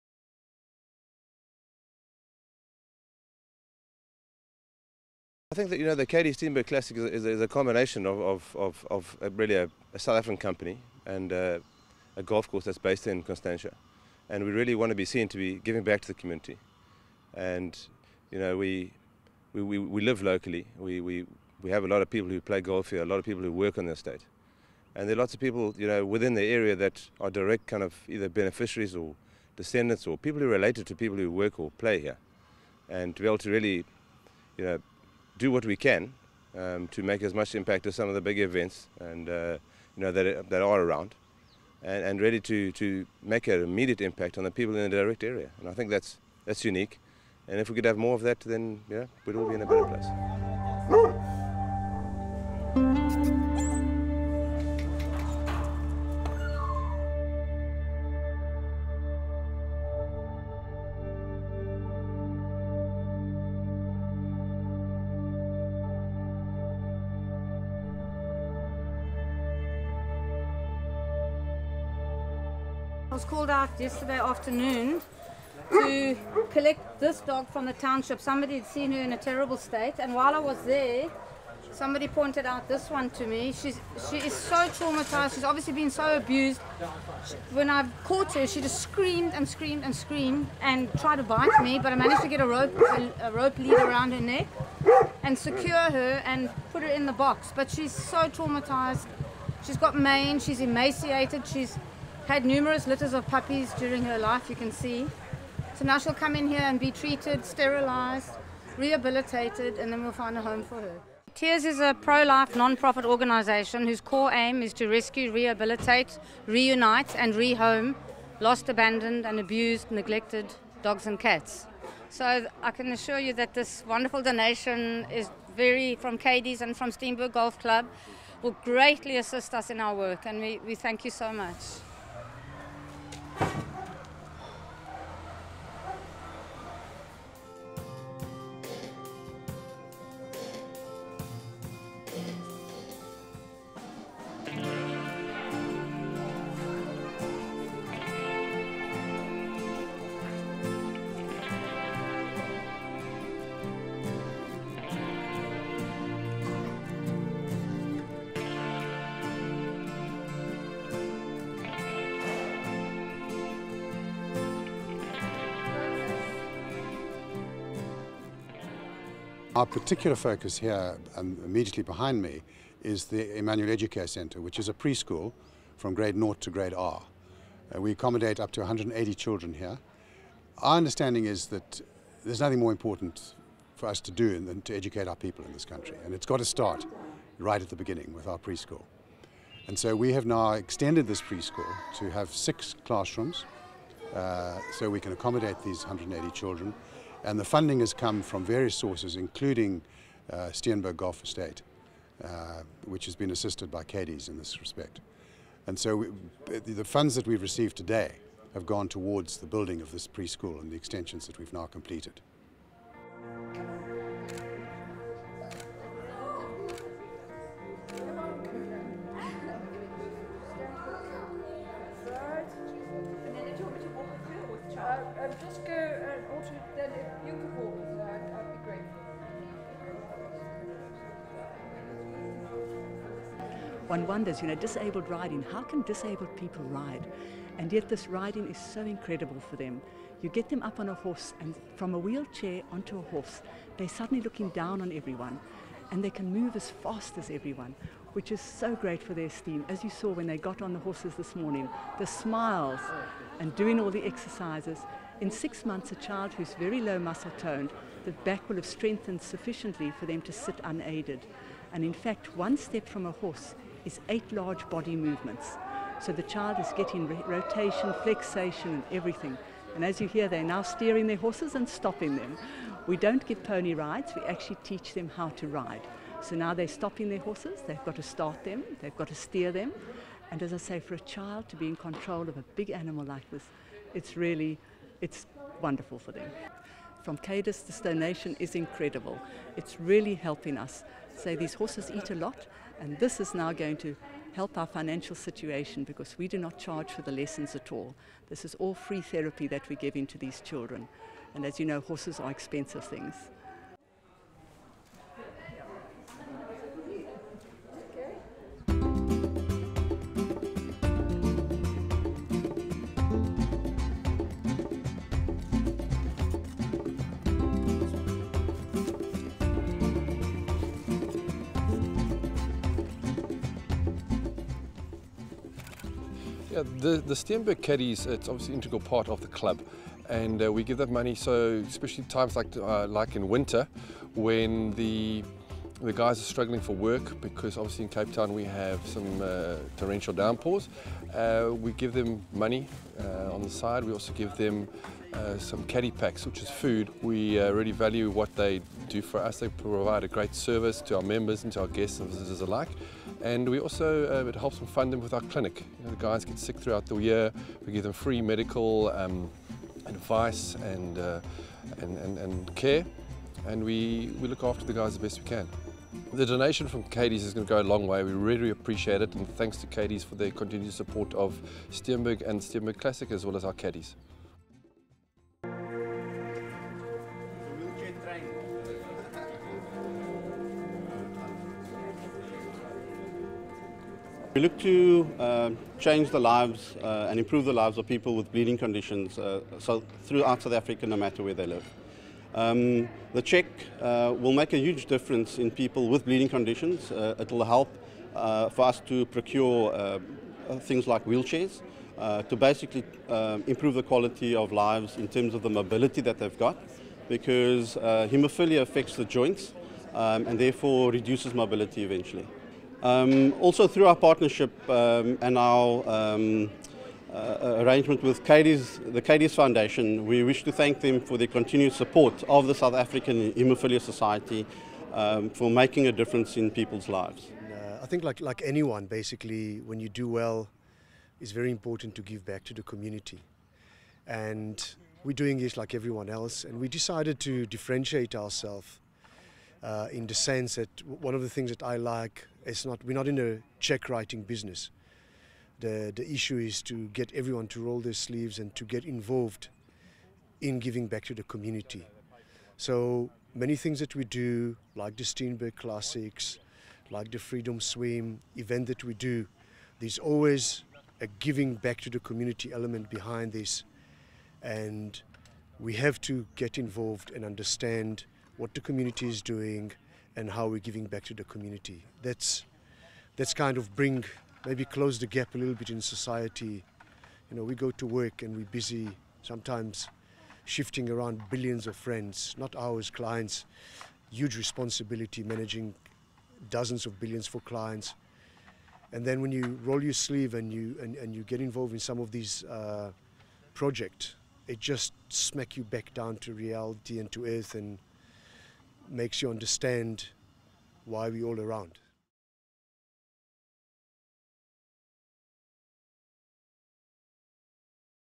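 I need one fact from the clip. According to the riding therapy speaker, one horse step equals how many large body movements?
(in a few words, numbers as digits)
8.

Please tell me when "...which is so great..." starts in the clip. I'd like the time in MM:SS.
04:08.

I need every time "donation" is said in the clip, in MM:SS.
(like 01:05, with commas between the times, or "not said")
02:04, 04:47, 06:06.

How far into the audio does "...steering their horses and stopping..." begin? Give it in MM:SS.
04:30.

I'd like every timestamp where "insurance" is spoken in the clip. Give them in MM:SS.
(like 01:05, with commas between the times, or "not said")
not said.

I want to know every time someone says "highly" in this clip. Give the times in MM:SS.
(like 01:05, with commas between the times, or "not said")
not said.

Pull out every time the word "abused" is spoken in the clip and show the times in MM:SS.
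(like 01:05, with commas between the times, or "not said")
01:26, 01:59.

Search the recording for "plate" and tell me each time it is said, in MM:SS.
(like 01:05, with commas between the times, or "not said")
not said.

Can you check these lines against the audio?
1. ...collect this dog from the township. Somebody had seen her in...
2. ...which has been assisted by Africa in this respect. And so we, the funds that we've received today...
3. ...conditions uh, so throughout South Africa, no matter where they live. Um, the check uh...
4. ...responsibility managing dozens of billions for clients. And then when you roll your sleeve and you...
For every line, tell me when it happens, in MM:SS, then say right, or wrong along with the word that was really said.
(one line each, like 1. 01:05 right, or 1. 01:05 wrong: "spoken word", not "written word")
1. 01:16 right
2. 03:22 wrong: "Cadiz", not "Africa"
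3. 06:28 right
4. 08:04 right.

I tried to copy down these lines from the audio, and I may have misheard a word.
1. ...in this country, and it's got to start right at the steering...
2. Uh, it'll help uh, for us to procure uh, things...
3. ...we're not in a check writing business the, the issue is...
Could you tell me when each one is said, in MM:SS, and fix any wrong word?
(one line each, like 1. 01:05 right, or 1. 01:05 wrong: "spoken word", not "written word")
1. 03:05 wrong: "beginning", not "steering"
2. 06:36 right
3. 07:22 right.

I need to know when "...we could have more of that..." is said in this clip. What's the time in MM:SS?
00:47.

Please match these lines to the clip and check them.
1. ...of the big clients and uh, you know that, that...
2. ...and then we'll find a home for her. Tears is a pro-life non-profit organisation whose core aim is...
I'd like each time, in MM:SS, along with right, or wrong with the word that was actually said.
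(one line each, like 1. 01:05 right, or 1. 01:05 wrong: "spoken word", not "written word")
1. 00:38 wrong: "events", not "clients"
2. 01:49 right.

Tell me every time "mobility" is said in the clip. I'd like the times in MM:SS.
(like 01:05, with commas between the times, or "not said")
06:45, 06:51.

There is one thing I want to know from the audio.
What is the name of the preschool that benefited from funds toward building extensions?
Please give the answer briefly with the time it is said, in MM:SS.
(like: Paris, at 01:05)
Emmanuel Educare Centre, at 02:53.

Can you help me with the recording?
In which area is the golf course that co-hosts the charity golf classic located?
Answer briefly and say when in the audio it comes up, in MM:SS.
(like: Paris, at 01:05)
Constantia, at 00:13.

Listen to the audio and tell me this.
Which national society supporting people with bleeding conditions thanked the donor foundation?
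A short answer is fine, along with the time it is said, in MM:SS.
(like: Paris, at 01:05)
South African Haemophilia Society, at 07:02.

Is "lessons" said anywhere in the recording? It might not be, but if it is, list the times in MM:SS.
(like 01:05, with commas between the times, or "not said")
04:57.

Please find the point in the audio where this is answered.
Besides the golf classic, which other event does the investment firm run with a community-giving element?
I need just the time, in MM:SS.
07:37.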